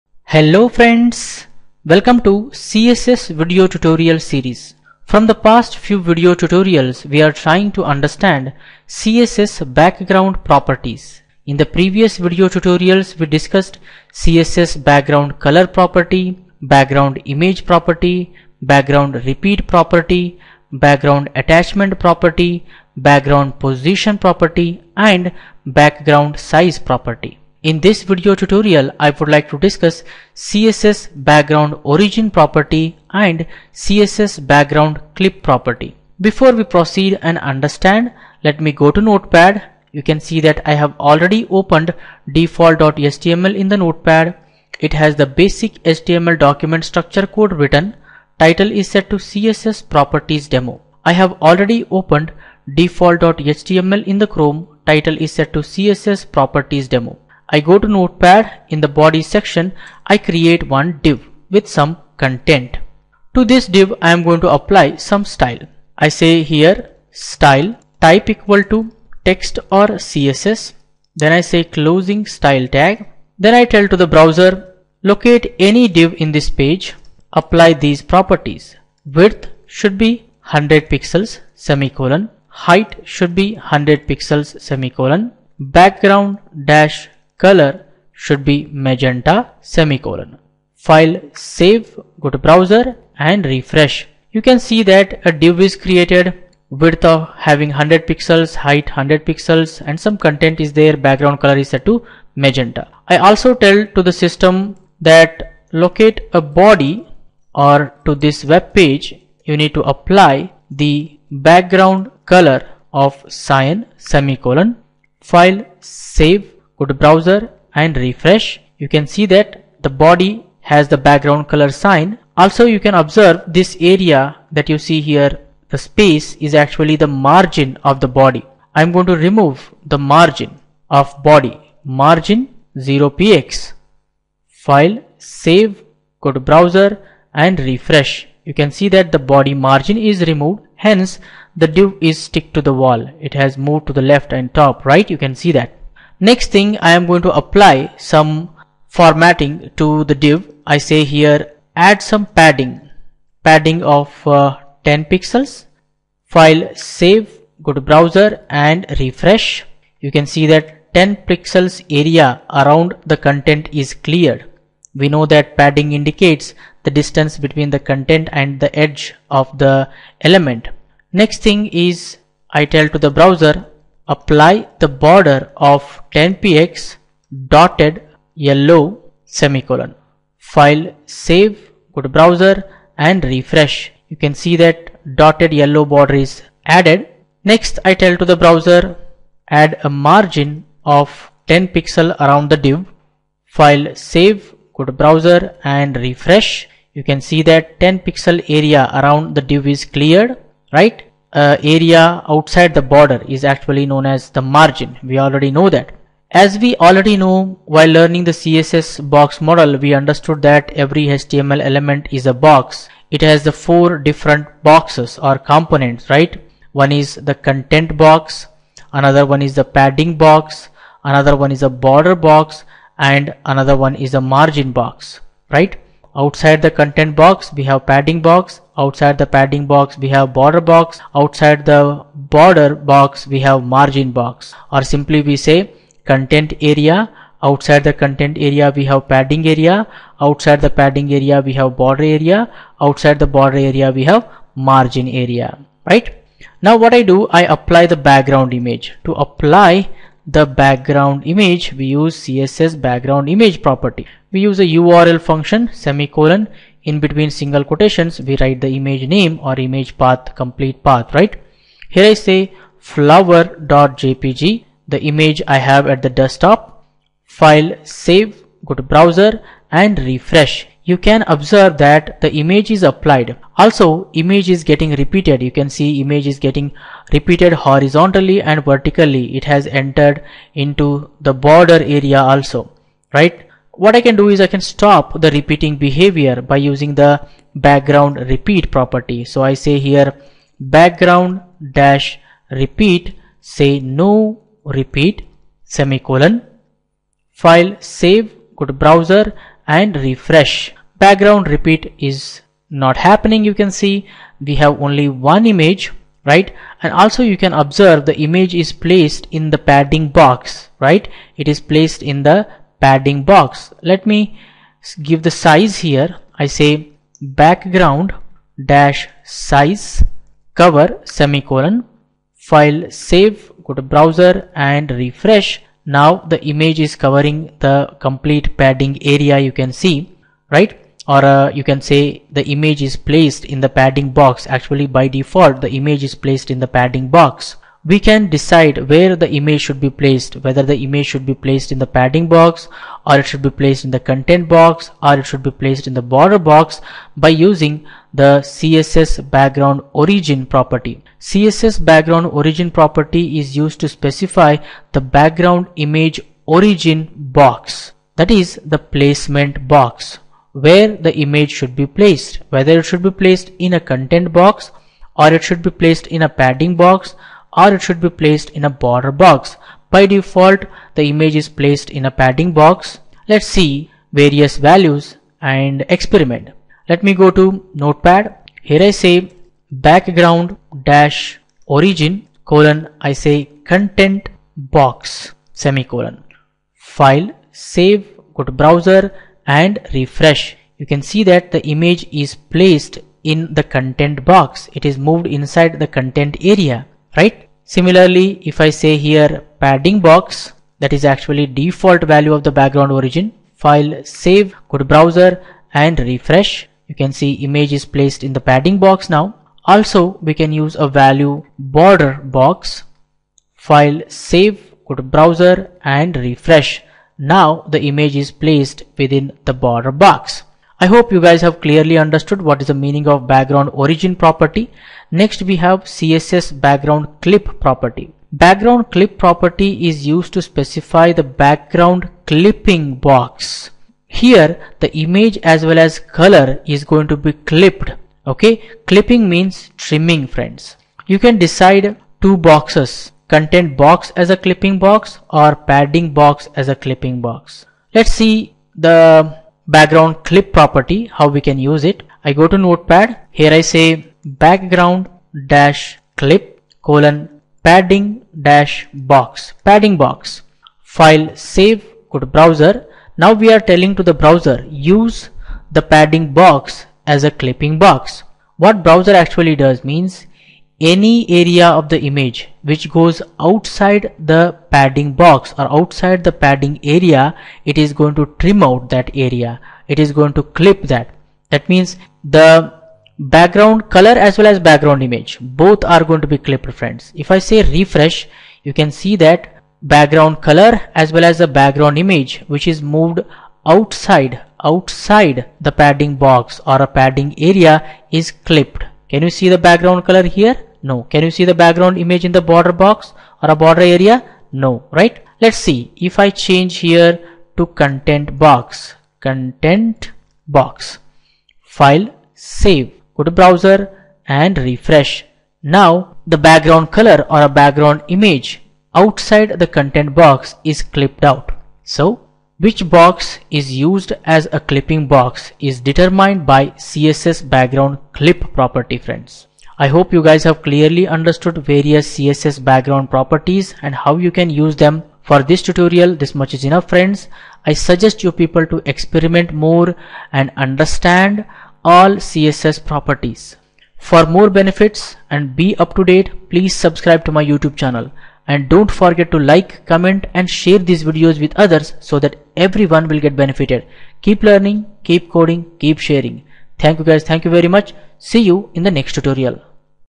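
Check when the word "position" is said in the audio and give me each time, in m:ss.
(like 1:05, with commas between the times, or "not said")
0:23.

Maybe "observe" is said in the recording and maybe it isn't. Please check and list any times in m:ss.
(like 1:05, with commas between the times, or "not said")
2:03, 4:31, 5:07.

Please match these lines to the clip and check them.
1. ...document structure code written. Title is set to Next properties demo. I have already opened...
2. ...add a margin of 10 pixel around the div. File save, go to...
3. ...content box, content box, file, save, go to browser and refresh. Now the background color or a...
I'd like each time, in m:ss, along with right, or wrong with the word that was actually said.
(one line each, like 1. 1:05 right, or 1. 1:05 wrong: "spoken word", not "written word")
1. 0:46 wrong: "CSS", not "Next"
2. 3:09 right
3. 8:27 right.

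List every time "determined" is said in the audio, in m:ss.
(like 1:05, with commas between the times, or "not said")
8:45.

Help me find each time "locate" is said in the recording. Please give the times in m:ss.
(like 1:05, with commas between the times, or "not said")
1:15, 1:45.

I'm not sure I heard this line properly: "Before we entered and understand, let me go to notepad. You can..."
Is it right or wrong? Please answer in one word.
wrong.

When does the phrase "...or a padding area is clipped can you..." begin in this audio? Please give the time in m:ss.
8:16.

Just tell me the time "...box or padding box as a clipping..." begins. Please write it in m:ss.
7:24.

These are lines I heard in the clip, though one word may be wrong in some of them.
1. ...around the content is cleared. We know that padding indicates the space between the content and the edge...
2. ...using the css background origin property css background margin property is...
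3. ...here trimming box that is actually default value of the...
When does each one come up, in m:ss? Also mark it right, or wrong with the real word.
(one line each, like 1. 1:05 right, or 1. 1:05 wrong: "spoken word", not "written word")
1. 2:42 wrong: "distance", not "space"
2. 5:47 wrong: "origin", not "margin"
3. 6:38 wrong: "padding", not "trimming".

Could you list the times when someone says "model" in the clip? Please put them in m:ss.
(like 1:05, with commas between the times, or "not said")
3:29.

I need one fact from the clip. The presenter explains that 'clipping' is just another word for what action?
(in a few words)
trimming.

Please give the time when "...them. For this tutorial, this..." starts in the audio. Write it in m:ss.
8:54.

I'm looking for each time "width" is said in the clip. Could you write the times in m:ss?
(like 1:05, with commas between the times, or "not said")
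1:19, 1:36.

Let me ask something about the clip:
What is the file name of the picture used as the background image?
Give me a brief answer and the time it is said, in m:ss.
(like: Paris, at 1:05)
flower.jpg, at 4:22.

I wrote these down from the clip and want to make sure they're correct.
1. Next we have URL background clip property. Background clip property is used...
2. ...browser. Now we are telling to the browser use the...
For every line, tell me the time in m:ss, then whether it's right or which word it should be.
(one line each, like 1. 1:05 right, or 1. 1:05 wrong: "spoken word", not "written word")
1. 7:05 wrong: "CSS", not "URL"
2. 7:42 right.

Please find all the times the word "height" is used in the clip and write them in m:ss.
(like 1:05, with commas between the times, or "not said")
1:22, 1:38.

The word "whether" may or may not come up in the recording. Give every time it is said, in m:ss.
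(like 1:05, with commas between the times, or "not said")
5:40, 6:02.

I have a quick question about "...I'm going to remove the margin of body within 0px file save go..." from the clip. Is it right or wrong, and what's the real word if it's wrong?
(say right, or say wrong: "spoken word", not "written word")
wrong: "margin", not "within".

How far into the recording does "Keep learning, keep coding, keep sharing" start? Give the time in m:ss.
9:14.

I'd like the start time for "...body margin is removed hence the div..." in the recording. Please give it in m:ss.
2:19.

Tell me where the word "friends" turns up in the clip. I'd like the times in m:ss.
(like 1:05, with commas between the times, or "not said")
0:00, 7:20, 8:06, 8:48, 8:56.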